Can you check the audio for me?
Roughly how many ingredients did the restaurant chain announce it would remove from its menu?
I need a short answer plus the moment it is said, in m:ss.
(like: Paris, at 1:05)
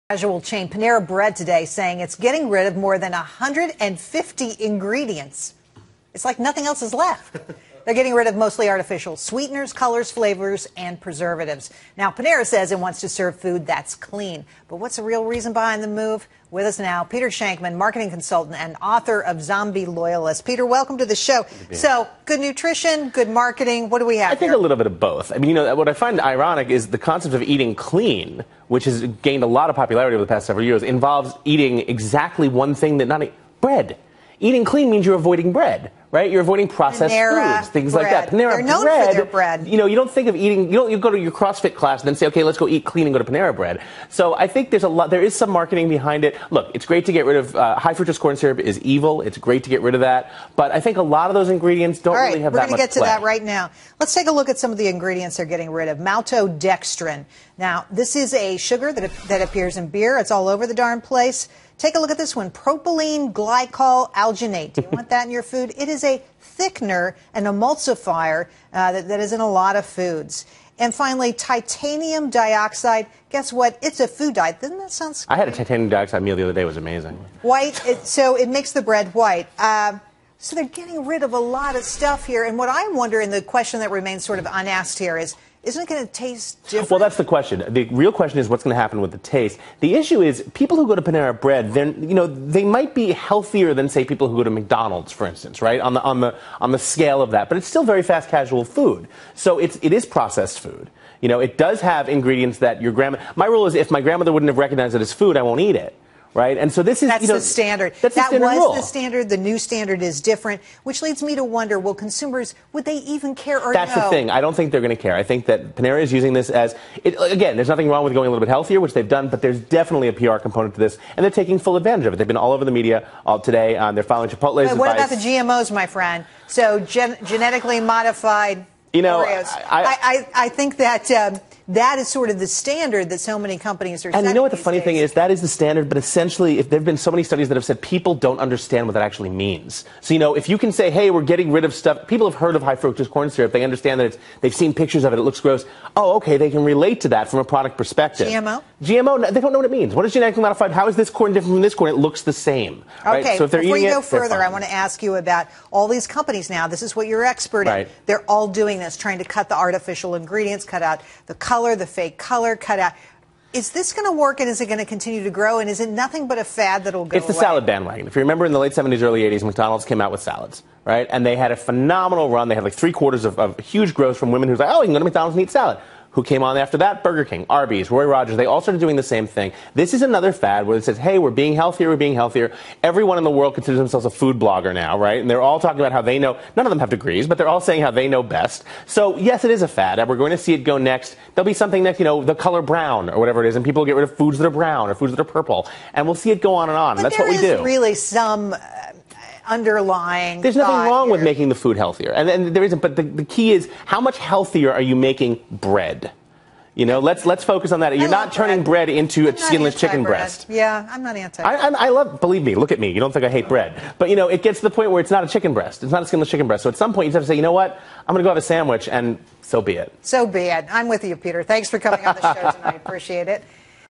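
more than 150, at 0:02.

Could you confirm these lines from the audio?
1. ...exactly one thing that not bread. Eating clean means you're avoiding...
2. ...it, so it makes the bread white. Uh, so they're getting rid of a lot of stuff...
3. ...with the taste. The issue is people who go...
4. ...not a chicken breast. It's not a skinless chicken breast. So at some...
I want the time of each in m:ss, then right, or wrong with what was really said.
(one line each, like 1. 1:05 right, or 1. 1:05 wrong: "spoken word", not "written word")
1. 0:31 right
2. 1:17 right
3. 1:29 right
4. 3:35 right.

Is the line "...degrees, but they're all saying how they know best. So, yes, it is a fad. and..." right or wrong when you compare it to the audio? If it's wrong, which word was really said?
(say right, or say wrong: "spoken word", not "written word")
right.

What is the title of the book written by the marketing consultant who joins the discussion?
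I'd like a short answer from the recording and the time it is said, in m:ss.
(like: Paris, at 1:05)
Zombie Loyalist, at 0:19.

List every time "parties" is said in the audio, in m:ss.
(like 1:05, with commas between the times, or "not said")
not said.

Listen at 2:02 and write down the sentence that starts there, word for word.
They've been all over the media all uh, today.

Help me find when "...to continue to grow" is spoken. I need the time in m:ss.
2:44.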